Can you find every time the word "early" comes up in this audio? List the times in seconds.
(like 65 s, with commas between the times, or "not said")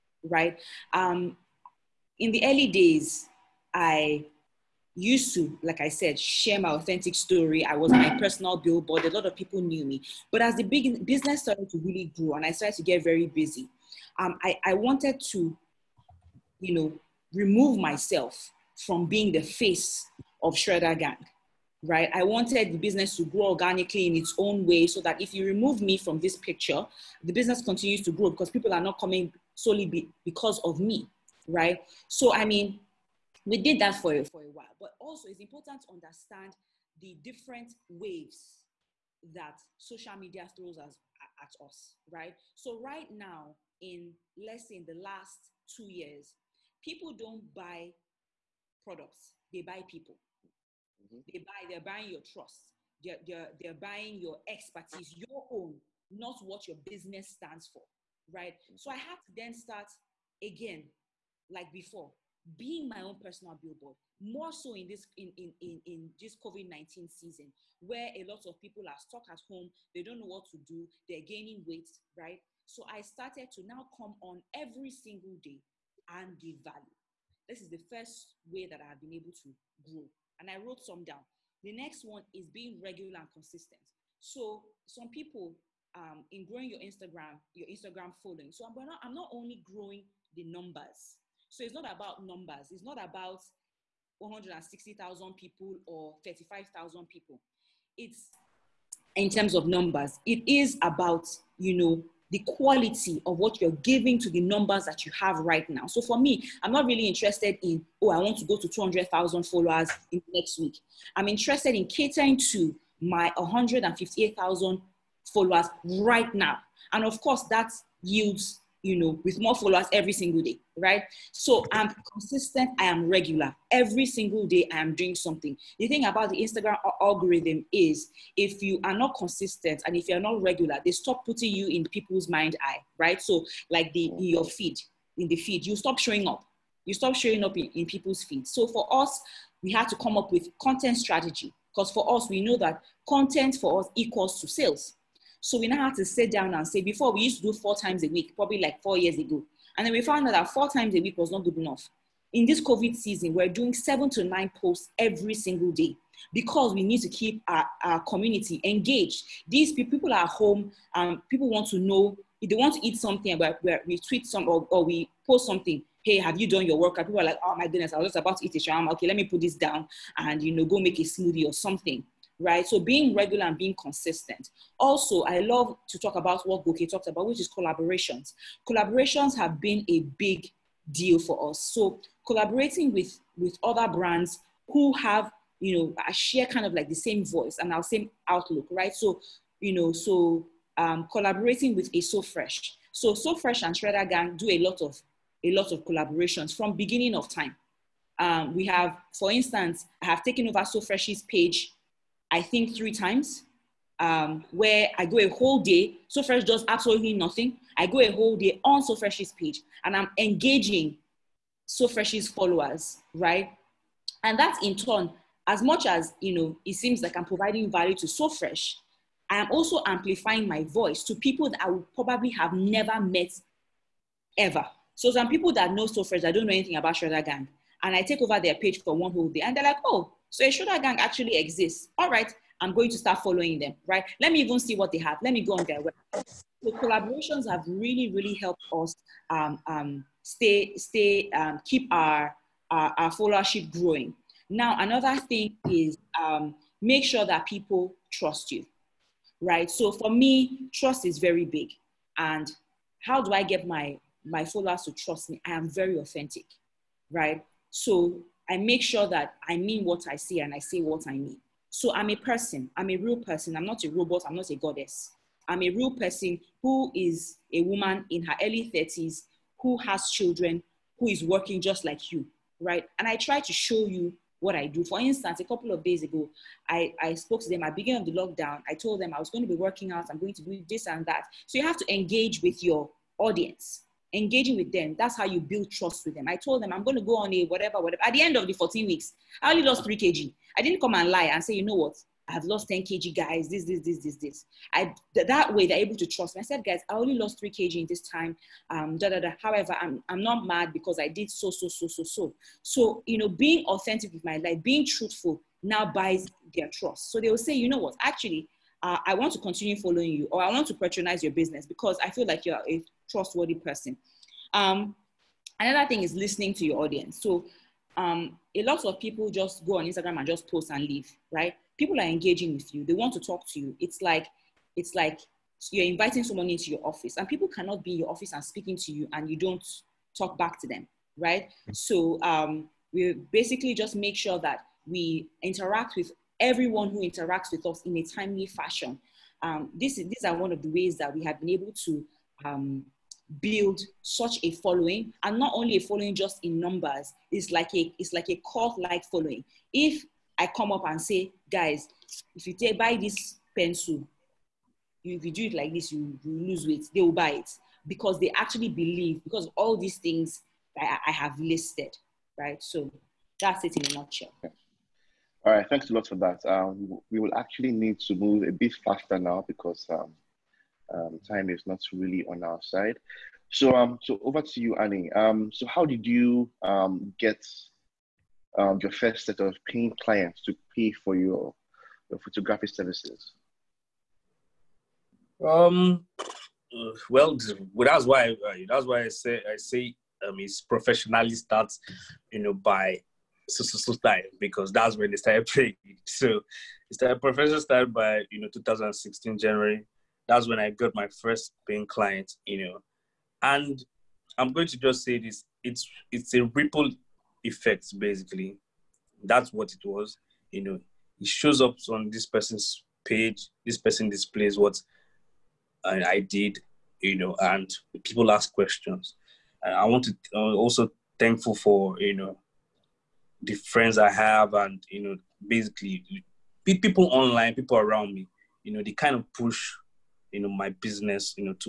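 2 s, 268 s.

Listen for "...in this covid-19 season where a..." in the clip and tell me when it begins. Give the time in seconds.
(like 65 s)
65 s.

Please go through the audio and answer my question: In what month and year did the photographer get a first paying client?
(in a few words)
January 2016.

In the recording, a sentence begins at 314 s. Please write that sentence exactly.
Um, another thing is listening to your audience.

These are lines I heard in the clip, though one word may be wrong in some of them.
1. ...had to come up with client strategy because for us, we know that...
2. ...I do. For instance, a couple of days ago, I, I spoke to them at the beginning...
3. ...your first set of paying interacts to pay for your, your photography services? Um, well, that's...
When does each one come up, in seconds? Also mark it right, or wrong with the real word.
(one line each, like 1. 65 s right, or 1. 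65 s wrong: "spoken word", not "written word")
1. 139 s wrong: "content", not "client"
2. 274 s right
3. 378 s wrong: "clients", not "interacts".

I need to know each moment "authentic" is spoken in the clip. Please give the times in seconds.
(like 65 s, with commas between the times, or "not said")
6 s, 255 s, 303 s.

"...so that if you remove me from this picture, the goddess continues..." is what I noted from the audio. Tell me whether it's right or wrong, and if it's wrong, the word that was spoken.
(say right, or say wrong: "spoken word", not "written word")
wrong: "business", not "goddess".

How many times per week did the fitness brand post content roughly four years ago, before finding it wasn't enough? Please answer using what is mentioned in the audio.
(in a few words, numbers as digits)
4.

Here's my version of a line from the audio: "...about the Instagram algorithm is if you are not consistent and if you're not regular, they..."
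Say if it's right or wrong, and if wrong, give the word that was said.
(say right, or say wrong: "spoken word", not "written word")
right.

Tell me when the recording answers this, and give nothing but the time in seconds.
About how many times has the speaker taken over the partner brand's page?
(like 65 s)
202 s.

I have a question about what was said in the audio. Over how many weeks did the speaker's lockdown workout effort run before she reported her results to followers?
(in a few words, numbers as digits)
14.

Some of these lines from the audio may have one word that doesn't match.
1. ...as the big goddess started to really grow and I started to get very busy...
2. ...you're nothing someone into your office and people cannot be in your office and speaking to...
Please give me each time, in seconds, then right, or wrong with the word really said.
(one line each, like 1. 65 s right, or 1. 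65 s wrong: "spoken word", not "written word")
1. 10 s wrong: "business", not "goddess"
2. 325 s wrong: "inviting", not "nothing".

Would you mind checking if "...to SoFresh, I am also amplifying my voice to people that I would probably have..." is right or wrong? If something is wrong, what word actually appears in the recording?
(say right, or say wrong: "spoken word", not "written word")
right.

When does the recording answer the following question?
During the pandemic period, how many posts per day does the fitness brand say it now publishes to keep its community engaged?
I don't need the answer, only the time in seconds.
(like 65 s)
153 s.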